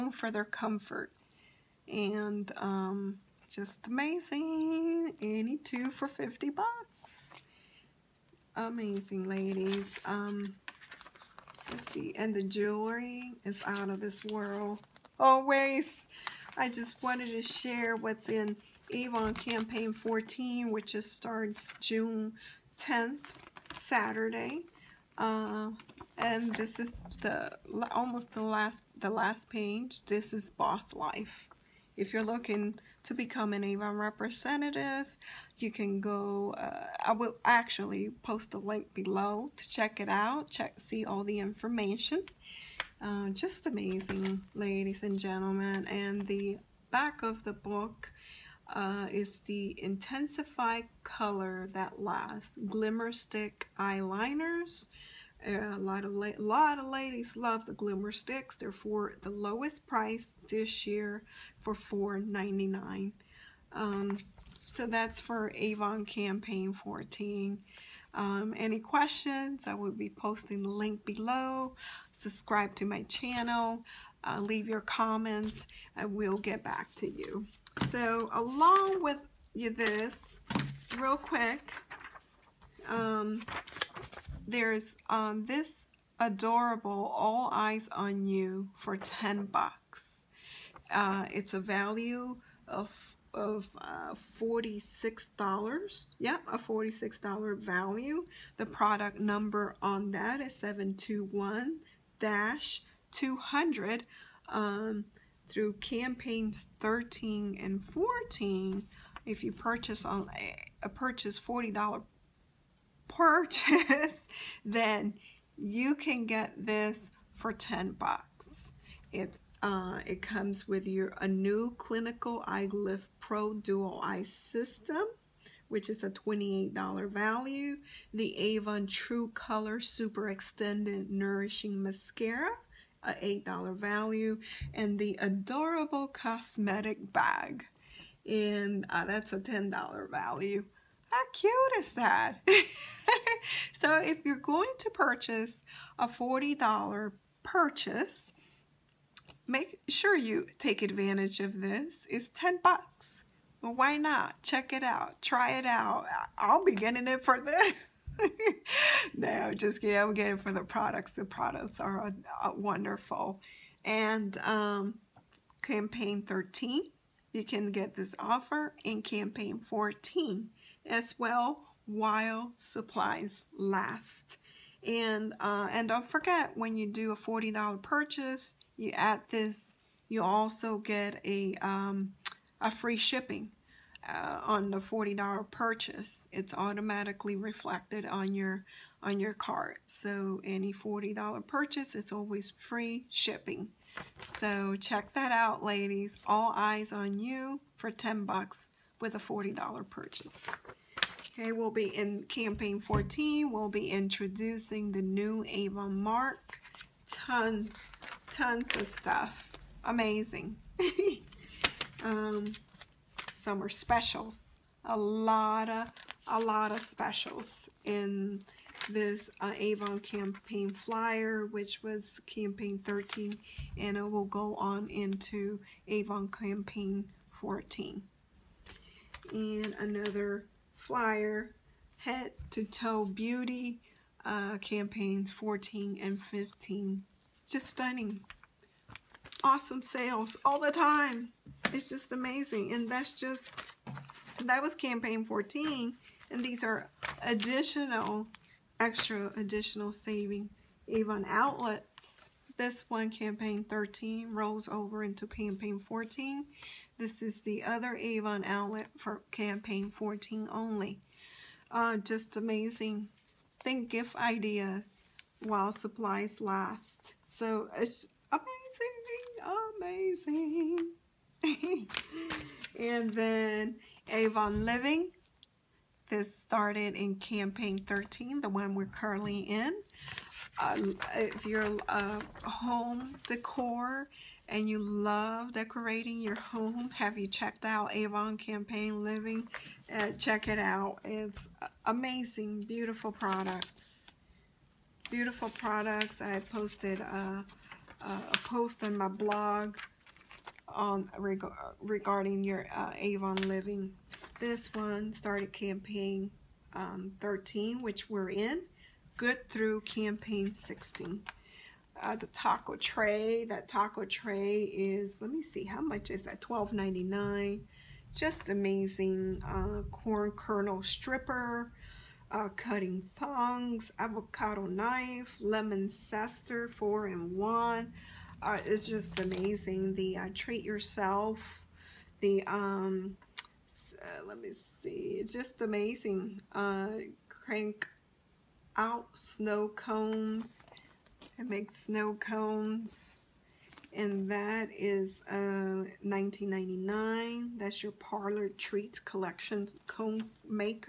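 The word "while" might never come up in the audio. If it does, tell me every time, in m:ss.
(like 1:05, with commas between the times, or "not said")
2:51, 4:25.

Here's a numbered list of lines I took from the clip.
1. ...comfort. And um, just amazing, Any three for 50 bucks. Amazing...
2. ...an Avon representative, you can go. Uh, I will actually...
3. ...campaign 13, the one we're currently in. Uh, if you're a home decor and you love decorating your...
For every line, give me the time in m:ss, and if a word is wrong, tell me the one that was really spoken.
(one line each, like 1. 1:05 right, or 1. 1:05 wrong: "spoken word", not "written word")
1. 0:00 wrong: "two", not "three"
2. 0:33 right
3. 4:37 right.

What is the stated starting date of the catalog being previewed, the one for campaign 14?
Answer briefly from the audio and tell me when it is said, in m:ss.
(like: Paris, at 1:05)
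June 10th, at 0:21.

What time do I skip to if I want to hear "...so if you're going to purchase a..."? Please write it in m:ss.
2:23.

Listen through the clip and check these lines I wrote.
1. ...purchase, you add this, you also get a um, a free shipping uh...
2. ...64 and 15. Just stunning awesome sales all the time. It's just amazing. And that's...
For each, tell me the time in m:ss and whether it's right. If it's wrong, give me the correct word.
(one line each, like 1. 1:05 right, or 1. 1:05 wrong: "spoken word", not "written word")
1. 2:57 right
2. 3:55 wrong: "14", not "64".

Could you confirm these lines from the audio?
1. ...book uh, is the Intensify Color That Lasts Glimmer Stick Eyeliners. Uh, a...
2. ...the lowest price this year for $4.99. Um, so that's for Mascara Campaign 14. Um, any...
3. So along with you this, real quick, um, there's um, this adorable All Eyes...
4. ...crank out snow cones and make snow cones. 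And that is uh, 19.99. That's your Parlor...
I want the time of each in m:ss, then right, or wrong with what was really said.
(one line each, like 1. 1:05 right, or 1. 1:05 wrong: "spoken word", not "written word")
1. 0:47 right
2. 0:59 wrong: "Avon", not "Mascara"
3. 1:17 right
4. 5:37 right.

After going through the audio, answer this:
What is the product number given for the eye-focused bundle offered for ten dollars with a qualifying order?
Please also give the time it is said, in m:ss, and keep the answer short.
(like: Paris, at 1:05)
721-200, at 1:40.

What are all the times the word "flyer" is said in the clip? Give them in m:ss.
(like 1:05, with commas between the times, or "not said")
3:40, 3:50.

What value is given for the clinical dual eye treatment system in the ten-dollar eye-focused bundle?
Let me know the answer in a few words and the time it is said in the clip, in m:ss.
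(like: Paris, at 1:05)
$28, at 2:06.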